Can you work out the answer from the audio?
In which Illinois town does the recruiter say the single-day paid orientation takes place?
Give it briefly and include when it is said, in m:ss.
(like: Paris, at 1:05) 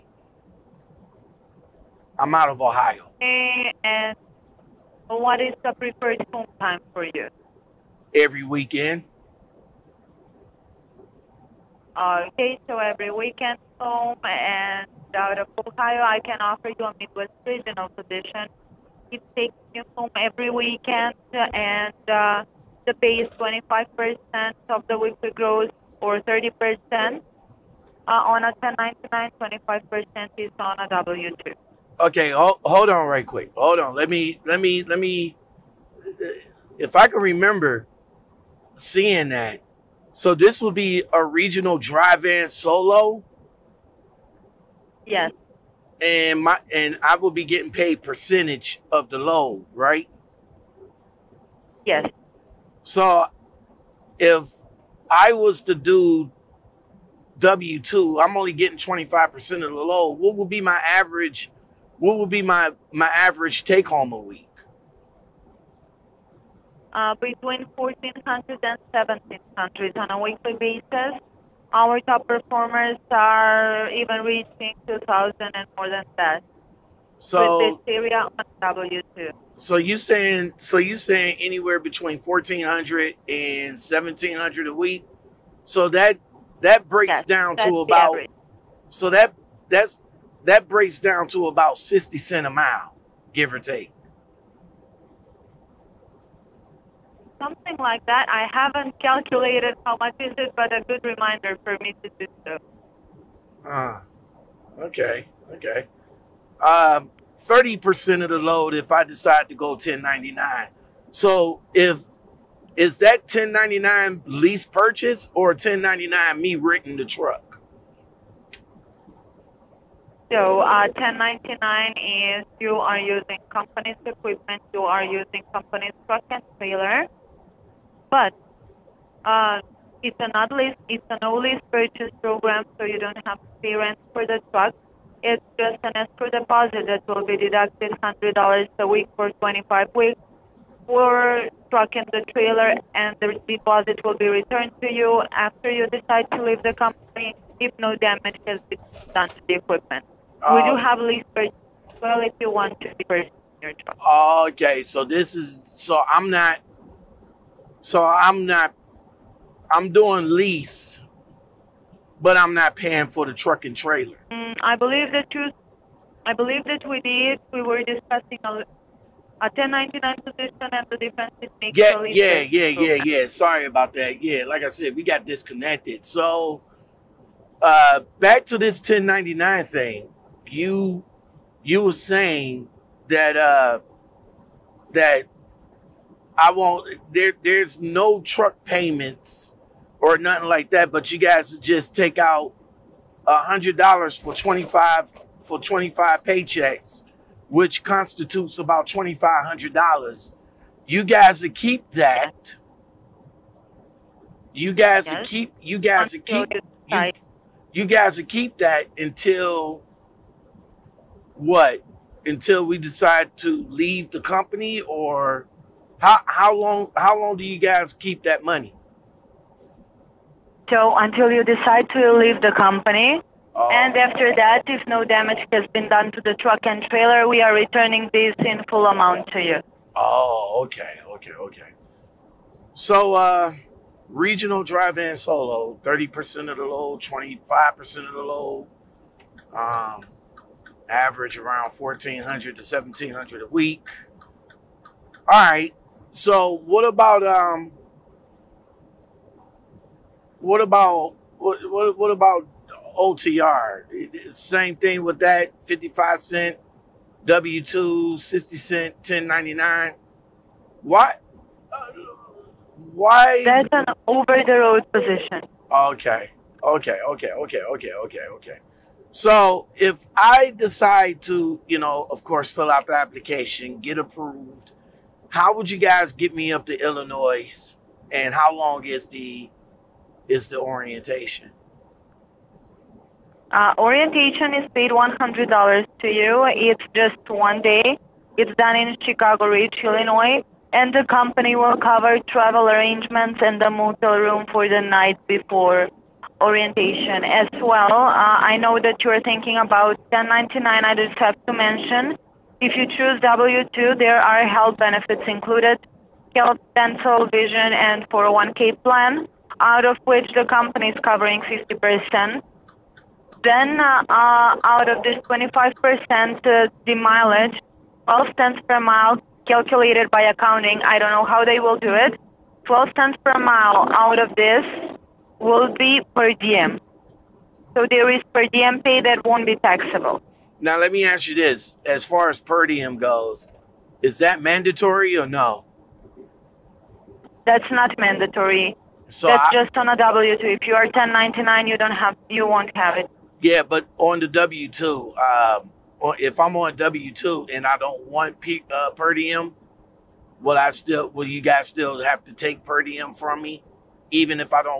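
Chicago Ridge, at 4:49.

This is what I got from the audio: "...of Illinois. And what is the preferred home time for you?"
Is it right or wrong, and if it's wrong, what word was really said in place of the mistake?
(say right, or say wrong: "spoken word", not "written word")
wrong: "Ohio", not "Illinois".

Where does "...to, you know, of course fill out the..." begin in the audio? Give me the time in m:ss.
4:31.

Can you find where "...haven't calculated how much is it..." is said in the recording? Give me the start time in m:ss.
1:38.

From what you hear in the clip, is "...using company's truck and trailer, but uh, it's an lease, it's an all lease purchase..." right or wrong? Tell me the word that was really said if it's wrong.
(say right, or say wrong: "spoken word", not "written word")
right.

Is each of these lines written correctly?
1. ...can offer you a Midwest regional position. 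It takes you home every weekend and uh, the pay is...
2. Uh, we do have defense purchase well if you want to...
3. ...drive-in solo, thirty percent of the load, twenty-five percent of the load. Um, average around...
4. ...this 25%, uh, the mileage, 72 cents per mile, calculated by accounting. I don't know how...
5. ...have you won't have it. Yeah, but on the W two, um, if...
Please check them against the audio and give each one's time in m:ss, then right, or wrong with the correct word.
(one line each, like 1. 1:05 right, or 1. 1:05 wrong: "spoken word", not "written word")
1. 0:16 right
2. 2:30 wrong: "lease", not "defense"
3. 3:54 right
4. 5:15 wrong: "12", not "72"
5. 5:41 right.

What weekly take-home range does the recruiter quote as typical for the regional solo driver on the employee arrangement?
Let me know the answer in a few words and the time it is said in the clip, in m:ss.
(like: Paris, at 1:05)
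1400 to 1700, at 1:07.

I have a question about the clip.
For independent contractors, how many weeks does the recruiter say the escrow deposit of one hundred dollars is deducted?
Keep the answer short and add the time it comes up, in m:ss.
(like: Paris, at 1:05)
25 weeks, at 2:19.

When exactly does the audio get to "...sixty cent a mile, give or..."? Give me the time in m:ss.
1:31.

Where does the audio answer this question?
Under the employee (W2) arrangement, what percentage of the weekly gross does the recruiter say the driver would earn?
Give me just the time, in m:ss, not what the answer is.
0:29.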